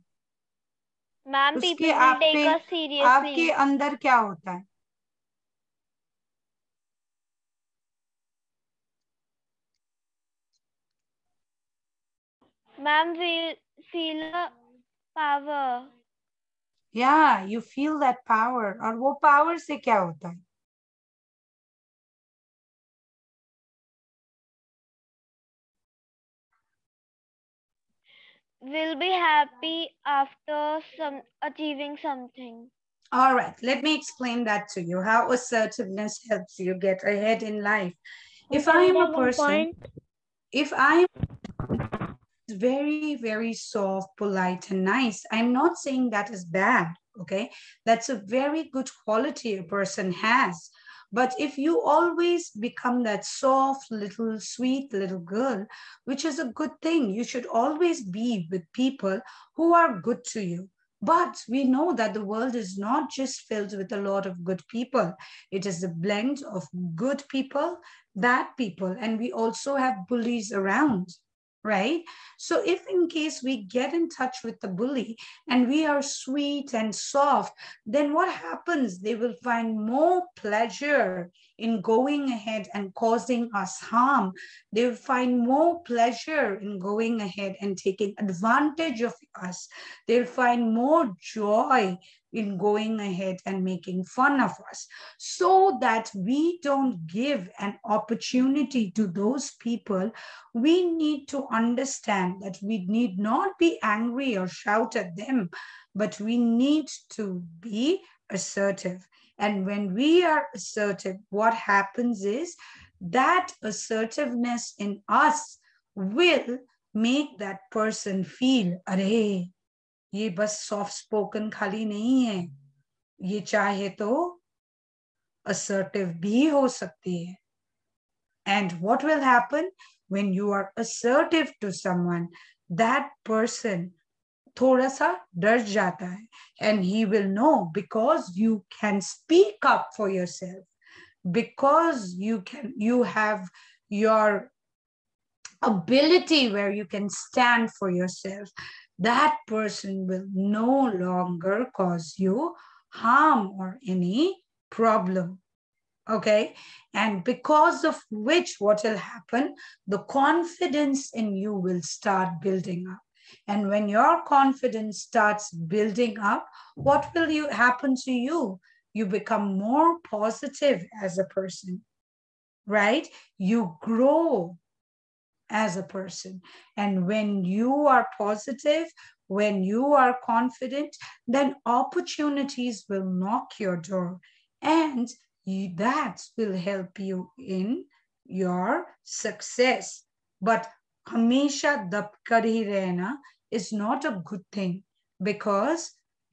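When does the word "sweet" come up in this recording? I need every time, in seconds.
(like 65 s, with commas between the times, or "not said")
54 s, 76 s.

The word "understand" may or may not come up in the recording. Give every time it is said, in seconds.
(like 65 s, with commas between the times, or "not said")
101 s.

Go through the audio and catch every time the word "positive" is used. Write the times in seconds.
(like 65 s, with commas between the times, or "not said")
170 s, 178 s.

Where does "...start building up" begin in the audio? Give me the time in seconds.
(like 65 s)
161 s.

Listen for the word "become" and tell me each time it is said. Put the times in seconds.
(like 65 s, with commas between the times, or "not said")
52 s, 169 s.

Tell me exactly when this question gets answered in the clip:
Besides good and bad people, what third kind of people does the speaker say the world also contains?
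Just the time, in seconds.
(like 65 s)
70 s.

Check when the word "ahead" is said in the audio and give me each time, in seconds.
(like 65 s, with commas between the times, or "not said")
37 s, 82 s, 87 s, 92 s.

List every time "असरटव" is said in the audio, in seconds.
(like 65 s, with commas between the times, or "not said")
125 s, 130 s.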